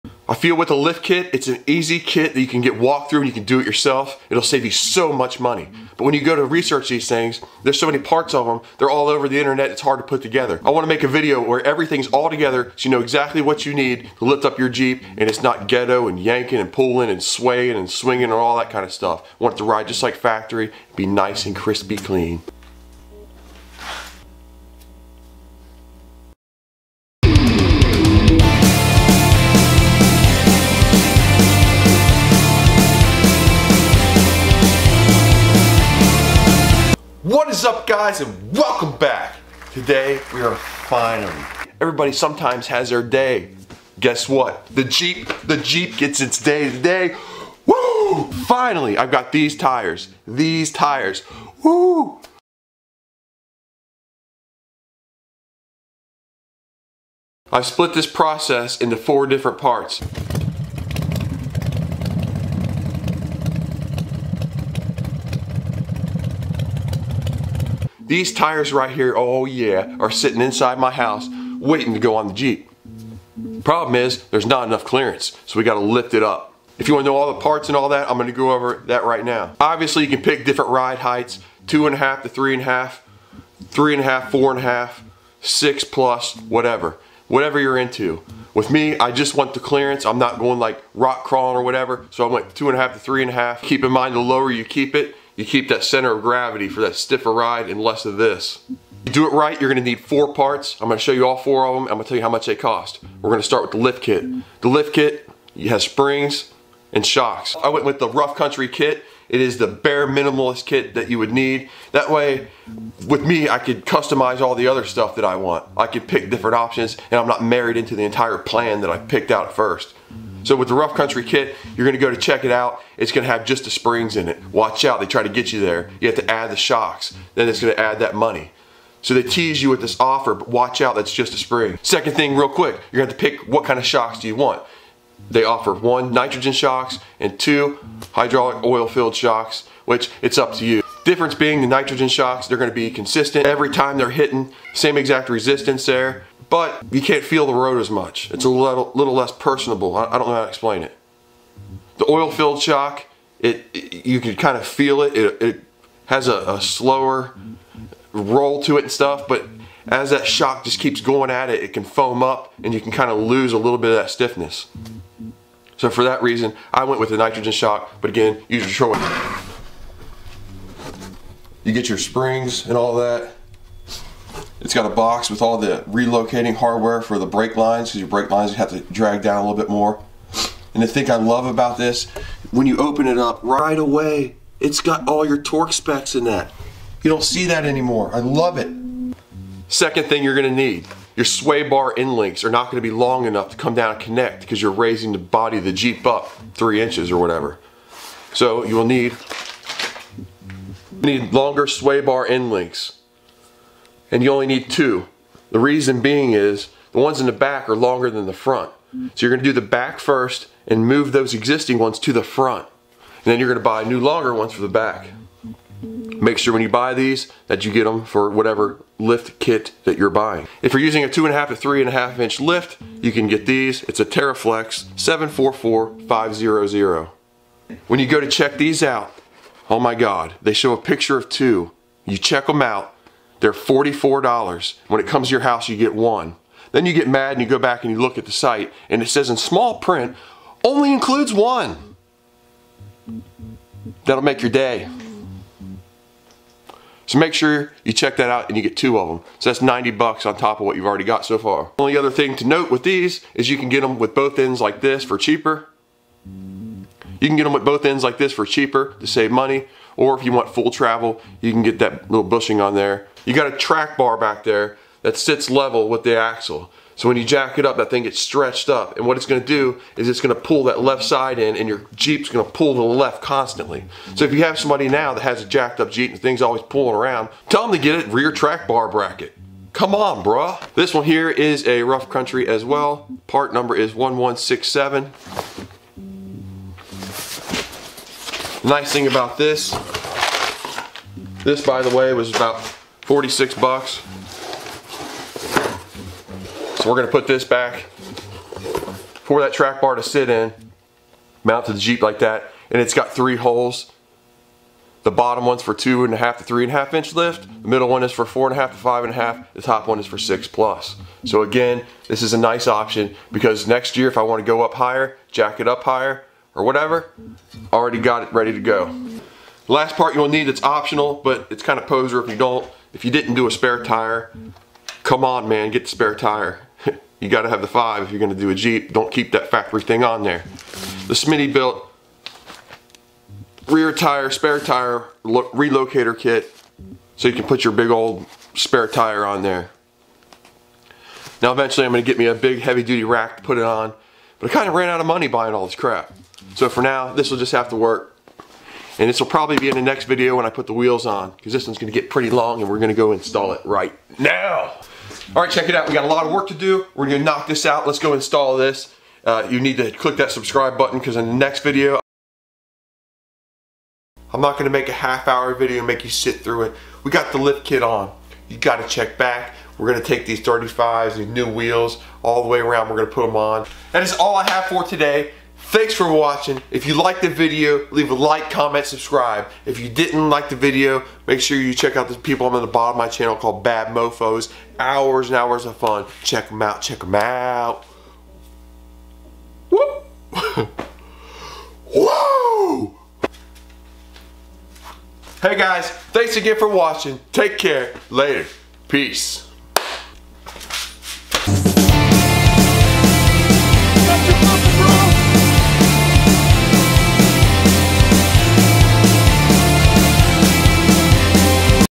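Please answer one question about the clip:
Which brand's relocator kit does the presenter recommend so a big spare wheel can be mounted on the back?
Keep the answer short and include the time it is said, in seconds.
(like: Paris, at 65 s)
Smittybilt, at 331 s.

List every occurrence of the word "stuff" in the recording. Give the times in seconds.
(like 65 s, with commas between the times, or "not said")
18 s, 114 s, 158 s.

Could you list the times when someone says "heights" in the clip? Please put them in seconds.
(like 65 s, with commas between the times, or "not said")
80 s.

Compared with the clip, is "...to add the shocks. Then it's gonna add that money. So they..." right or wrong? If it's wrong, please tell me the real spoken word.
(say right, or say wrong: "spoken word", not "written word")
right.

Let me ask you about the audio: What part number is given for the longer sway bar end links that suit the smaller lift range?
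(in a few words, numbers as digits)
TeraFlex 744500.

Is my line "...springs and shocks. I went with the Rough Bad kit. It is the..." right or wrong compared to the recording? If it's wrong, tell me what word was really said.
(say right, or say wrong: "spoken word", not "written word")
wrong: "Country", not "Bad".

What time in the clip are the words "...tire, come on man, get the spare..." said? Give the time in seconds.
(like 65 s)
323 s.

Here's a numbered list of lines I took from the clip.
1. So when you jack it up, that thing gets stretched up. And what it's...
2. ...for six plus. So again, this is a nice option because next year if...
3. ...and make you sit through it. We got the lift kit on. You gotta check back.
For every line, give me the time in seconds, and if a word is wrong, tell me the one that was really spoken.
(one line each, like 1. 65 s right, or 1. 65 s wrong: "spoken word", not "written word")
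1. 266 s right
2. 310 s right
3. 365 s right.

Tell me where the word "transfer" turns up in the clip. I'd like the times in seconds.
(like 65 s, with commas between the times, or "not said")
not said.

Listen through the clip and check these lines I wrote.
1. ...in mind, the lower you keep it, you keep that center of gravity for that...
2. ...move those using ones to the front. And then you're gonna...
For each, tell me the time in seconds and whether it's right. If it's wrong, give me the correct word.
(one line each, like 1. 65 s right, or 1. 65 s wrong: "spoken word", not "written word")
1. 93 s right
2. 210 s wrong: "existing", not "using".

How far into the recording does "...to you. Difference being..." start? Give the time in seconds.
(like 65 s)
140 s.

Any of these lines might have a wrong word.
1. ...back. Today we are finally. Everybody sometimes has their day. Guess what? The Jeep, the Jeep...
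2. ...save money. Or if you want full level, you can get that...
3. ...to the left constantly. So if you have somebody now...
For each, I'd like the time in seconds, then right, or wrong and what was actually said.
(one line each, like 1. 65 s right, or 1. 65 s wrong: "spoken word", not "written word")
1. 38 s right
2. 259 s wrong: "travel", not "level"
3. 272 s right.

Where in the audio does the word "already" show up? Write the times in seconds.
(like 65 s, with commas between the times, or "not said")
250 s, 317 s.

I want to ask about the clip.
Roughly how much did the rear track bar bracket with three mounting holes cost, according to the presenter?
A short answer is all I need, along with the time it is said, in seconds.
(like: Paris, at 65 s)
$46, at 293 s.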